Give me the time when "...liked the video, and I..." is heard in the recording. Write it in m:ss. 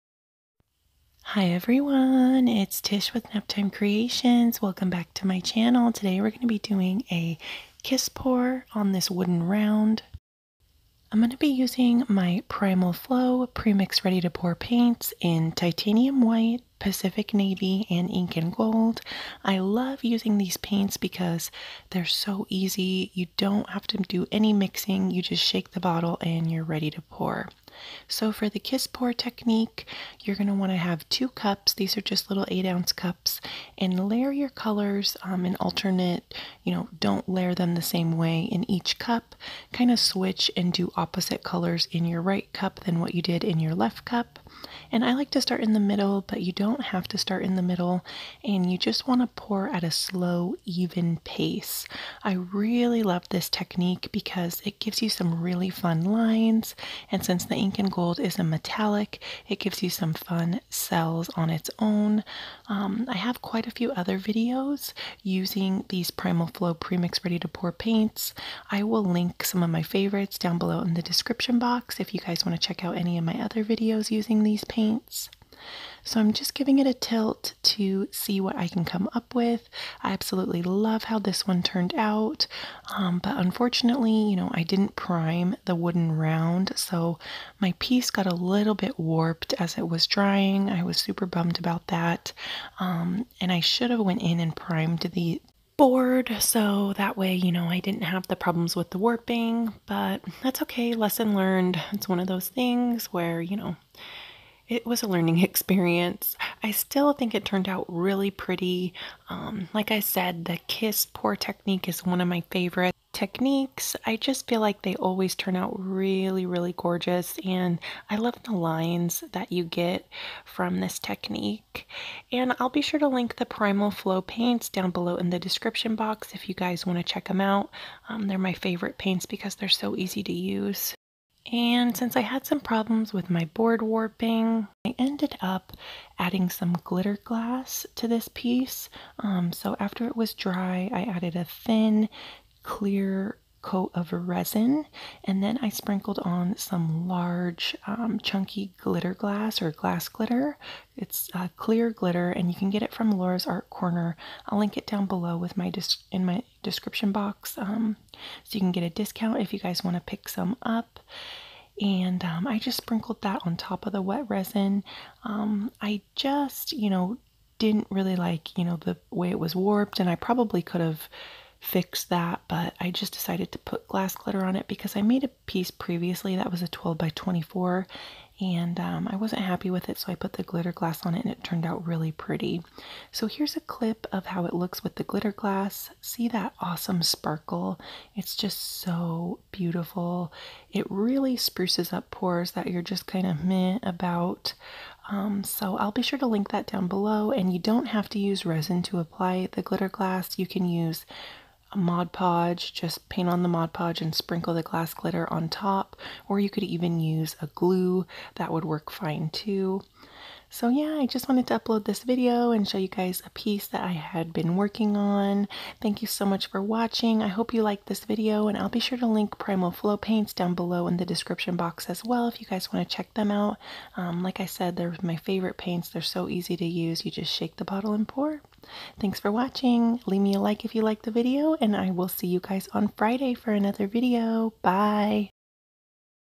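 3:50.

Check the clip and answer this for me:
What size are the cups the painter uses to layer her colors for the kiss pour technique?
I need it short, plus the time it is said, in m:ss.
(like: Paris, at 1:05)
8 ounce, at 0:32.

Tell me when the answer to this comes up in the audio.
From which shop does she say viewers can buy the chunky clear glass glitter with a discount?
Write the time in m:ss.
2:33.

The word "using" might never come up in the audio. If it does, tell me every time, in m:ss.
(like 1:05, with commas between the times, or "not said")
0:11, 0:20, 1:05, 1:14.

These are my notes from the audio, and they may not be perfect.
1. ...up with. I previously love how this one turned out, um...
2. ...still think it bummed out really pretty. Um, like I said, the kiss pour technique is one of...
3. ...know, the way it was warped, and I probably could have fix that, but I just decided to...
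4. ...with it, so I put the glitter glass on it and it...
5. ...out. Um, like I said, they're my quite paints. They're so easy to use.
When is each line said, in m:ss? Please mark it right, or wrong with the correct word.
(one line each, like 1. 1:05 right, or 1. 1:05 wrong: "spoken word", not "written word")
1. 1:19 wrong: "absolutely", not "previously"
2. 1:46 wrong: "turned", not "bummed"
3. 2:48 right
4. 2:59 right
5. 3:43 wrong: "favorite", not "quite".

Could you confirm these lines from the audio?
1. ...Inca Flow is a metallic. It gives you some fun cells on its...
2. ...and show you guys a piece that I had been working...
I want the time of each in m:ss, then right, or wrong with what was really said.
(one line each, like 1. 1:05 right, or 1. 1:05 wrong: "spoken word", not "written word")
1. 0:57 wrong: "Gold", not "Flow"
2. 3:32 right.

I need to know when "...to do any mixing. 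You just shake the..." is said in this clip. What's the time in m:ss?
0:23.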